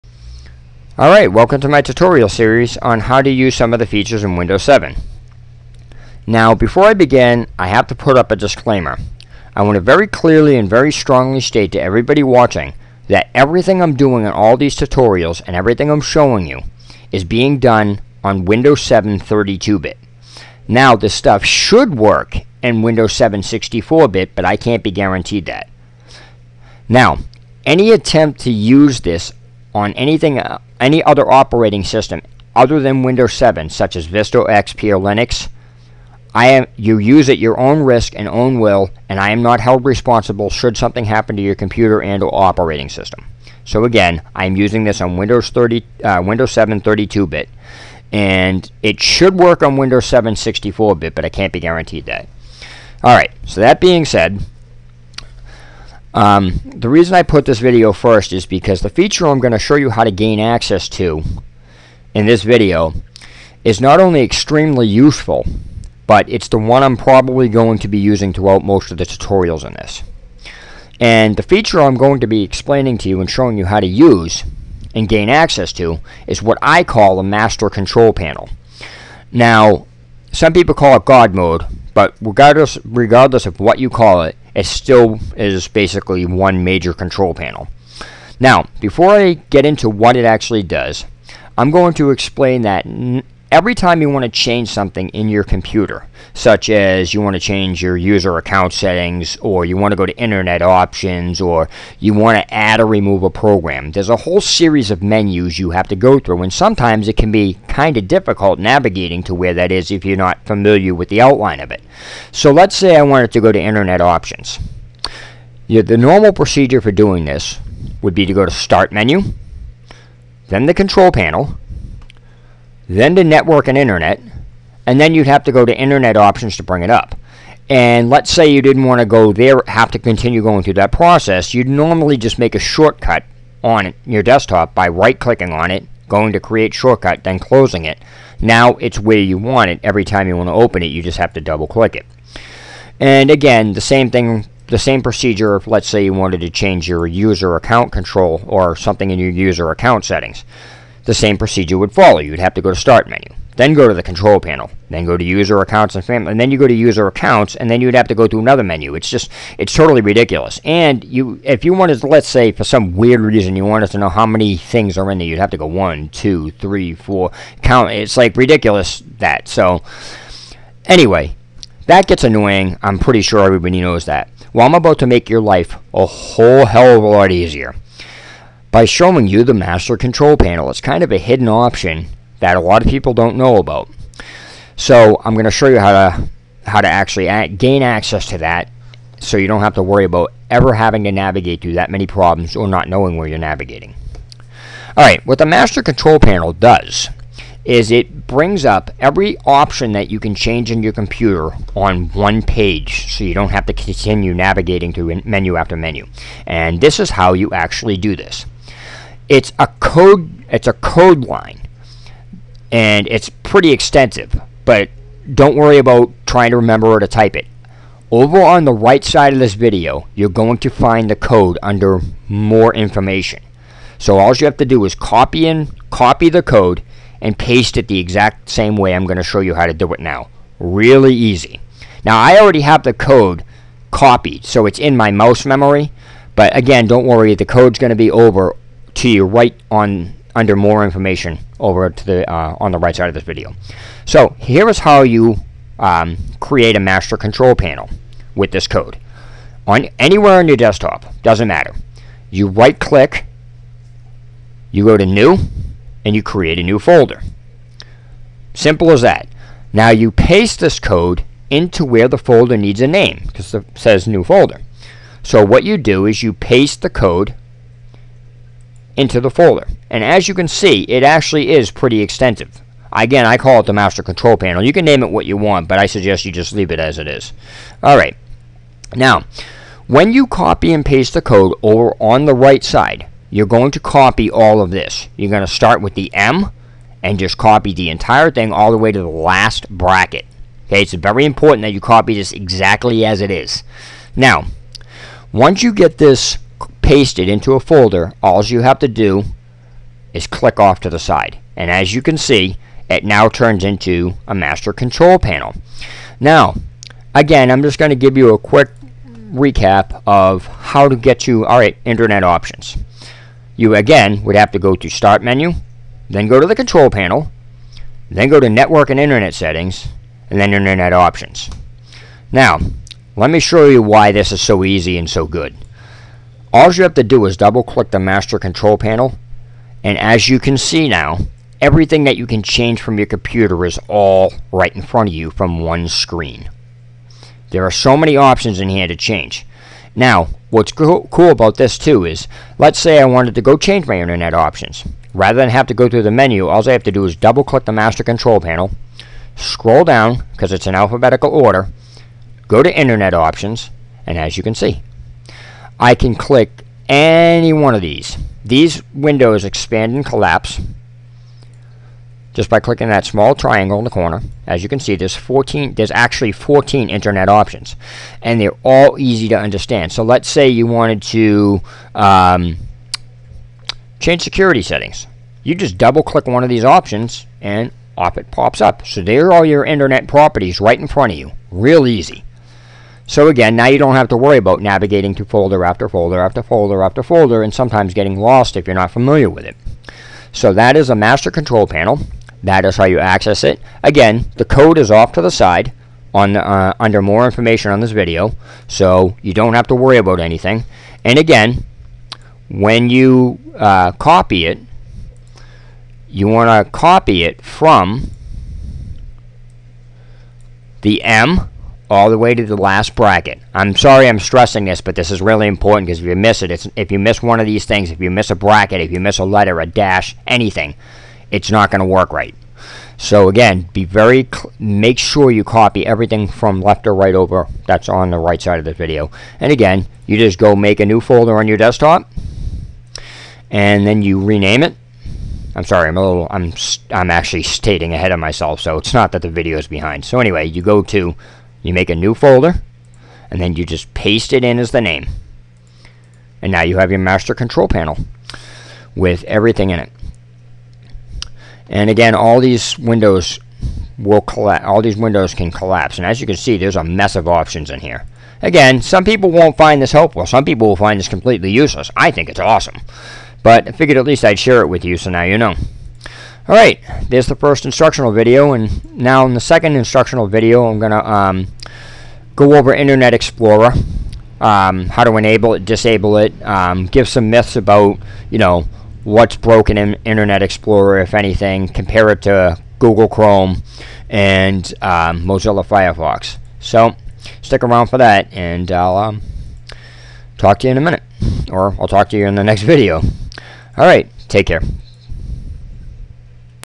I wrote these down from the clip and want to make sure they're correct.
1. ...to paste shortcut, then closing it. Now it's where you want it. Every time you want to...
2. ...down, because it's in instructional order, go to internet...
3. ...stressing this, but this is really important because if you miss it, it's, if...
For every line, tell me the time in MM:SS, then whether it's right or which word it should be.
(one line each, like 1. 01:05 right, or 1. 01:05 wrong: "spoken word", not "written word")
1. 02:16 wrong: "create", not "paste"
2. 05:49 wrong: "alphabetical", not "instructional"
3. 06:54 right.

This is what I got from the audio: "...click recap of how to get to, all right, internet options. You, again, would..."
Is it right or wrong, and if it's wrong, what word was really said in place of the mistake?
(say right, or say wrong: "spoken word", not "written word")
wrong: "quick", not "click".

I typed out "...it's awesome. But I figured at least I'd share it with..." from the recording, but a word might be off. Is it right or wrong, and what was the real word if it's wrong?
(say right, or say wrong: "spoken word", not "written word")
right.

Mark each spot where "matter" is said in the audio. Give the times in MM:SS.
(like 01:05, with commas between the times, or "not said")
04:11.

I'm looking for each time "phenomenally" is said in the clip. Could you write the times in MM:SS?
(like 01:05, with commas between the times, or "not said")
not said.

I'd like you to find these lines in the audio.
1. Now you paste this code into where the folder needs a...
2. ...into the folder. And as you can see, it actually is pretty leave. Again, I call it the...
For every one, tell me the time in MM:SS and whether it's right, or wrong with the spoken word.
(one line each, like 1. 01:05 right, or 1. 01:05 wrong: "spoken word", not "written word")
1. 04:19 right
2. 04:28 wrong: "extensive", not "leave".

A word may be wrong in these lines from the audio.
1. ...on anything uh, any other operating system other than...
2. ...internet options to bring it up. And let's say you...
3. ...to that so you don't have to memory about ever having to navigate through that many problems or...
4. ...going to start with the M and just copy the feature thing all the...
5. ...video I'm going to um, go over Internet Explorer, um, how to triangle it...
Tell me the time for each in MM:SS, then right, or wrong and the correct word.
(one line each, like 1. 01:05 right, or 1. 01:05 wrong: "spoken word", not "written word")
1. 00:29 right
2. 02:05 right
3. 03:08 wrong: "worry", not "memory"
4. 04:45 wrong: "entire", not "feature"
5. 07:50 wrong: "enable", not "triangle".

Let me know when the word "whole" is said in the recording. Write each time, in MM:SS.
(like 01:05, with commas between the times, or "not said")
01:44, 02:56.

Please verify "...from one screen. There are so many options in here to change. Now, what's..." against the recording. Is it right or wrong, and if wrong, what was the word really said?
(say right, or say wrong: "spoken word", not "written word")
right.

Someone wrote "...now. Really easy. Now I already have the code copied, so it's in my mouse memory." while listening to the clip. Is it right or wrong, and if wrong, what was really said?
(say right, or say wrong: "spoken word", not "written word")
right.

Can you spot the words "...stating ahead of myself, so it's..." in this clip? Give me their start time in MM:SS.
07:17.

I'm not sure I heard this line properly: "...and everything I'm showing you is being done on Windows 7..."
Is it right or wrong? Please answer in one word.
right.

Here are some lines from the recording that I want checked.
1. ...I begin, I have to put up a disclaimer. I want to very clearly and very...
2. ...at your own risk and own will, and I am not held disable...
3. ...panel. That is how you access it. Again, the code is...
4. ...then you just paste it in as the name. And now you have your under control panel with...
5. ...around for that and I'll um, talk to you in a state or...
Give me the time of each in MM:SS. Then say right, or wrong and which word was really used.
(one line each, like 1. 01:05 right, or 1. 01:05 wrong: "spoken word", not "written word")
1. 00:06 right
2. 00:37 wrong: "responsible", not "disable"
3. 06:31 right
4. 07:23 wrong: "master", not "under"
5. 08:07 wrong: "minute", not "state".